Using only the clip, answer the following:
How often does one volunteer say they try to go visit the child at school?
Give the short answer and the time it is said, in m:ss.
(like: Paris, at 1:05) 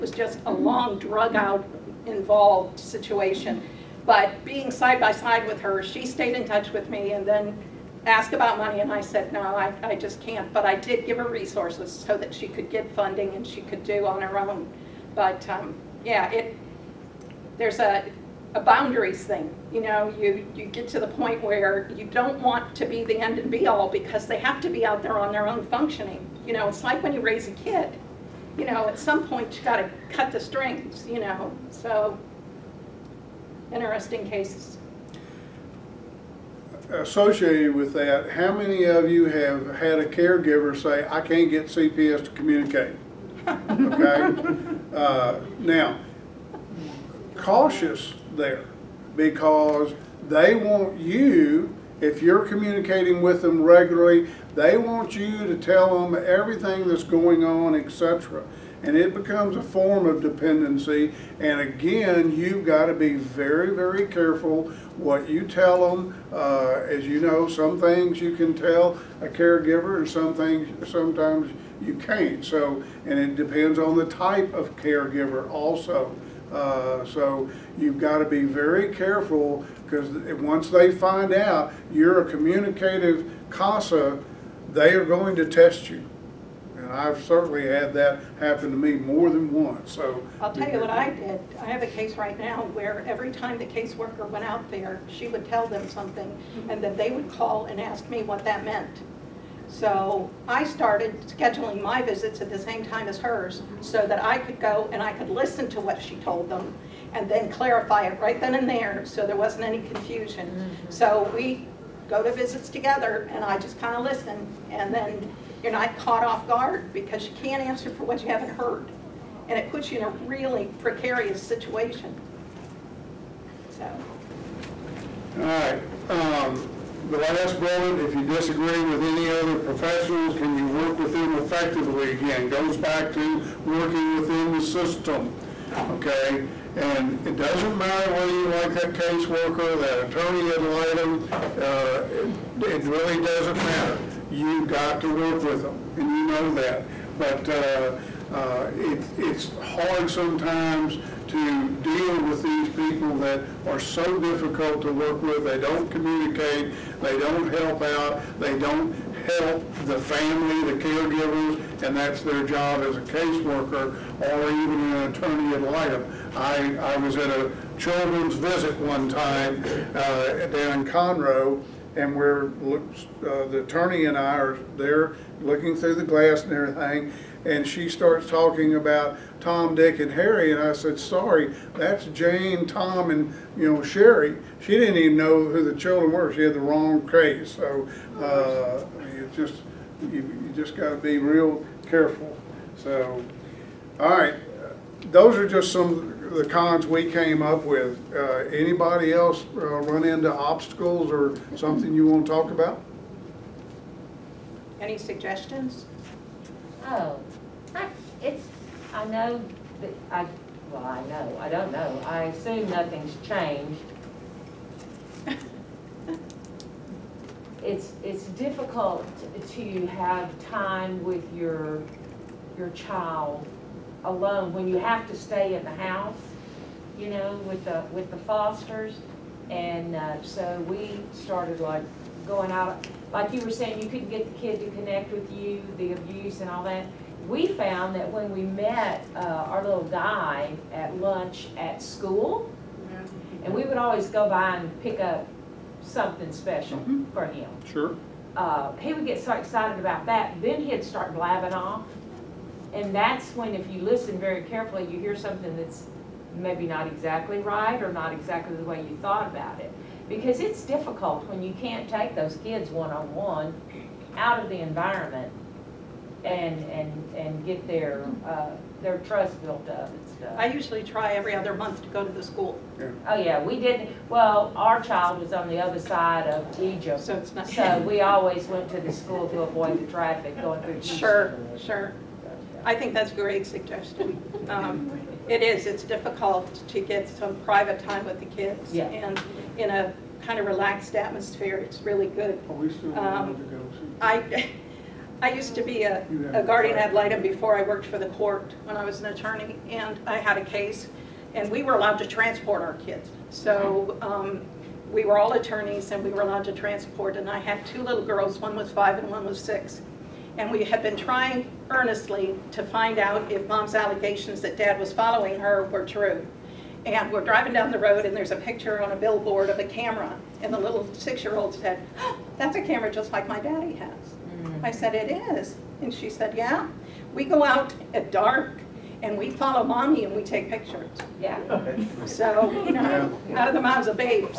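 Every other month, at 4:31.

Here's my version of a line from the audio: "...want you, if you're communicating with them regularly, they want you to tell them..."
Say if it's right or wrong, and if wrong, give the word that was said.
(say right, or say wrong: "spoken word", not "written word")
right.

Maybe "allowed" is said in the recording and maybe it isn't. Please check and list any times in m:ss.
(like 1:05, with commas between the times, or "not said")
5:01, 5:06.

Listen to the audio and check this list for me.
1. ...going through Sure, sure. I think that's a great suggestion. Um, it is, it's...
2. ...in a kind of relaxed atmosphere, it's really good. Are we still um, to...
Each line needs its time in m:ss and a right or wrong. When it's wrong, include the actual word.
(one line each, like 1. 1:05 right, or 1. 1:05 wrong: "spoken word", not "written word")
1. 4:40 right
2. 4:49 right.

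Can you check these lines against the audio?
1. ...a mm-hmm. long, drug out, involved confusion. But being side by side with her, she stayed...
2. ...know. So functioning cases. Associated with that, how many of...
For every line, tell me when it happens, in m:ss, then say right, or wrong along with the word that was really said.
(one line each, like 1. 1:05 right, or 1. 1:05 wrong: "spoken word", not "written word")
1. 0:00 wrong: "situation", not "confusion"
2. 0:31 wrong: "interesting", not "functioning".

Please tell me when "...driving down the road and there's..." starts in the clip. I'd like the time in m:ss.
5:17.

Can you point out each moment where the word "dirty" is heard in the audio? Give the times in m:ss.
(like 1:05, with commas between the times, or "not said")
not said.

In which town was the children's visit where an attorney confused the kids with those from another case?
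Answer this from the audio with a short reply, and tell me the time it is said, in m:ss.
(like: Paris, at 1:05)
Conroe, at 2:50.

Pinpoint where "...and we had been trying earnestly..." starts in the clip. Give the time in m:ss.
5:10.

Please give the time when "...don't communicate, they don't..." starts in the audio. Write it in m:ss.
2:35.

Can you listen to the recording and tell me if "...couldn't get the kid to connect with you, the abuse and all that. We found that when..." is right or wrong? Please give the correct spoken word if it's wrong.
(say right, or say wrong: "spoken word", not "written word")
right.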